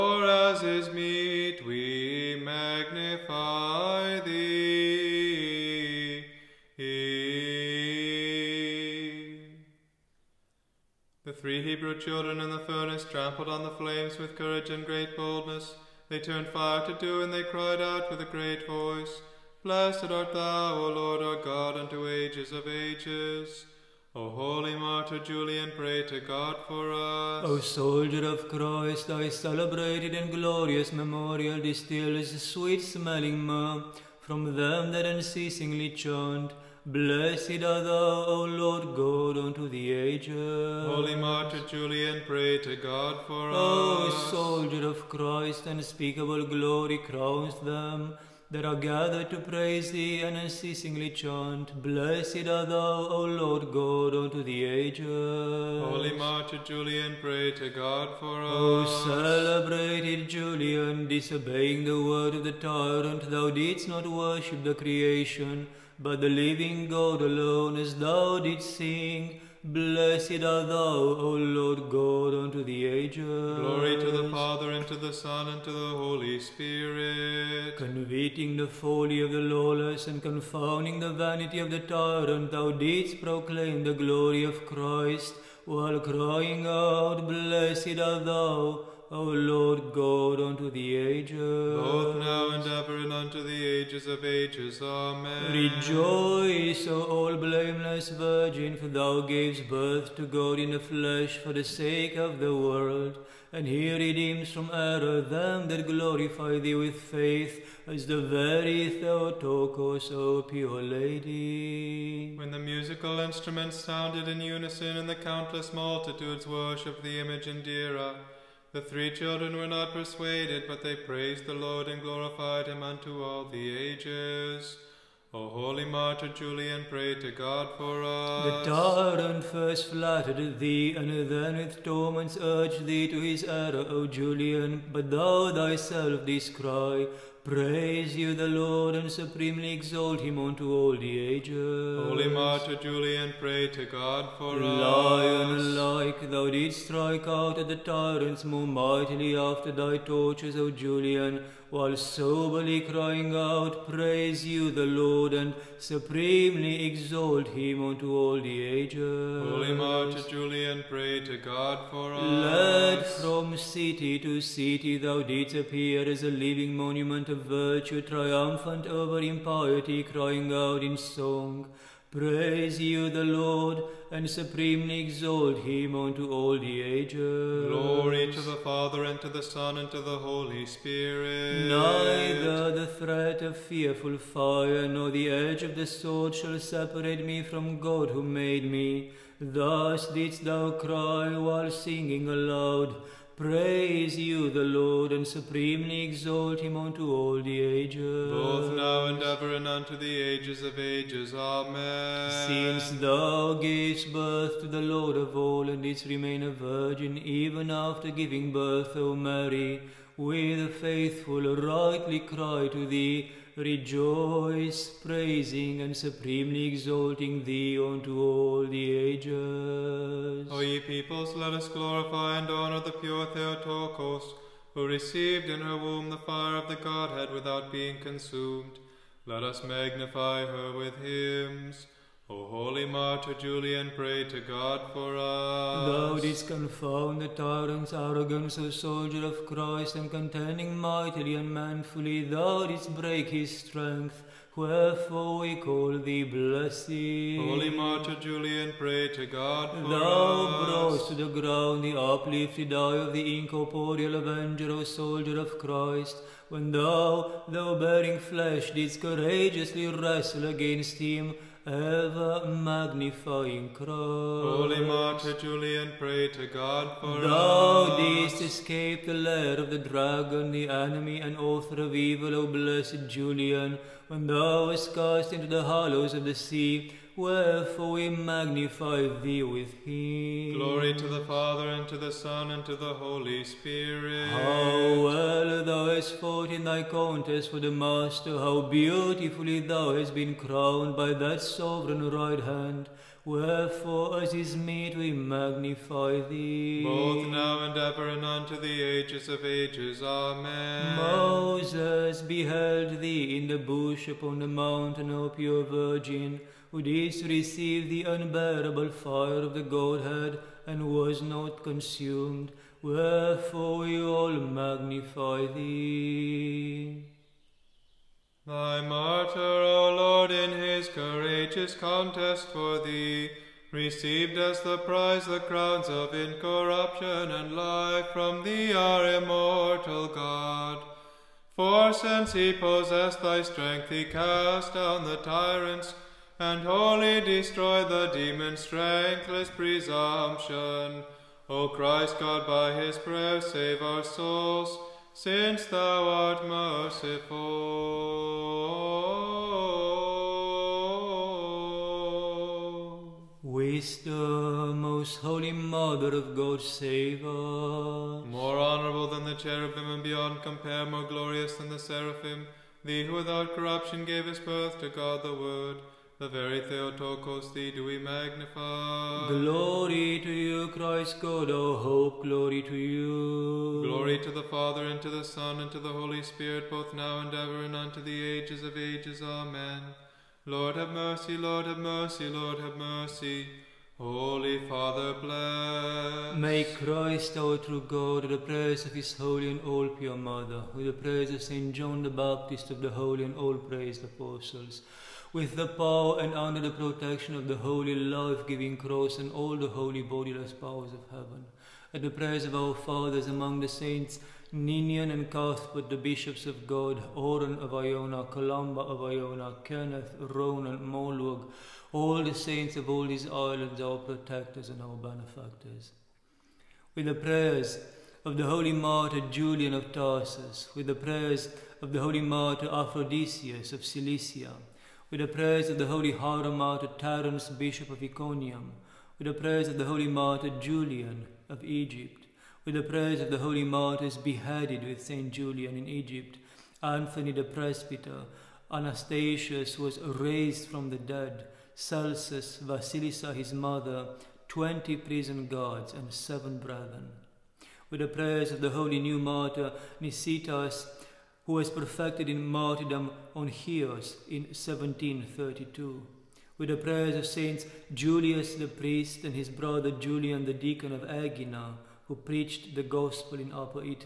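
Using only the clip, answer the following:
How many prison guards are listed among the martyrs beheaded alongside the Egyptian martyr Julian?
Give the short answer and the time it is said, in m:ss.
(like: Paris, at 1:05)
20, at 7:24.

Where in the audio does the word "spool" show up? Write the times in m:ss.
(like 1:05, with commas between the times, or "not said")
not said.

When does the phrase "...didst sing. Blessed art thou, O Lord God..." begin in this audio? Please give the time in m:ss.
1:08.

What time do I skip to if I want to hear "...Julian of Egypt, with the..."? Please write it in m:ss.
7:10.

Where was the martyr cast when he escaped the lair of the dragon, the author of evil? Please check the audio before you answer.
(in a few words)
hollows of the sea.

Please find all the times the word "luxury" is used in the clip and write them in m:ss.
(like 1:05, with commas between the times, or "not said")
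not said.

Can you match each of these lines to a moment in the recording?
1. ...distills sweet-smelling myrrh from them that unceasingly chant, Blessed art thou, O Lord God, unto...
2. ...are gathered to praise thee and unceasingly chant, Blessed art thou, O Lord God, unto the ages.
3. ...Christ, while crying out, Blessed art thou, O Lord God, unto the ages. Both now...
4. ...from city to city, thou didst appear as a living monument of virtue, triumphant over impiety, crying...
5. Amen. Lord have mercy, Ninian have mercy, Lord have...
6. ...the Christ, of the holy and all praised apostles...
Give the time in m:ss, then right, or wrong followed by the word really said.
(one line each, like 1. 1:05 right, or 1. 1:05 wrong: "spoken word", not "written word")
1. 0:31 right
2. 0:48 right
3. 1:24 right
4. 2:43 right
5. 6:19 wrong: "Lord", not "Ninian"
6. 6:32 wrong: "Baptist", not "Christ".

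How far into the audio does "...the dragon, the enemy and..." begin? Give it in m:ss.
4:29.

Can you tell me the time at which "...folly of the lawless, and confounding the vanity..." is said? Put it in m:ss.
1:18.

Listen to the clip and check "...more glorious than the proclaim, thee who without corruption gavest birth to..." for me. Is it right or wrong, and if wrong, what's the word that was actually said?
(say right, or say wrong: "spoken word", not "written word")
wrong: "seraphim", not "proclaim".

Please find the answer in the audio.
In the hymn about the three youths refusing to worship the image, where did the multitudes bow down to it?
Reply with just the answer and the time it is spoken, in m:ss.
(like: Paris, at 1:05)
Dira, at 1:57.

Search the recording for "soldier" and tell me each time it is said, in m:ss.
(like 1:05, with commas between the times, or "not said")
0:27, 0:44, 3:58, 4:14.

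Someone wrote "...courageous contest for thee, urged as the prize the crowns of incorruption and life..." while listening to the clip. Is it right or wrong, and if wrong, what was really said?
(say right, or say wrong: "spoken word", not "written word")
wrong: "received", not "urged".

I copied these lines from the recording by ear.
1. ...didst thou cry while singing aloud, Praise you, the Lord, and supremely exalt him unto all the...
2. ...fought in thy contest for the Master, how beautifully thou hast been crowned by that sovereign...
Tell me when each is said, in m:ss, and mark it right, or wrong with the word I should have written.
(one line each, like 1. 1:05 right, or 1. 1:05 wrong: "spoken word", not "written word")
1. 3:10 right
2. 4:46 right.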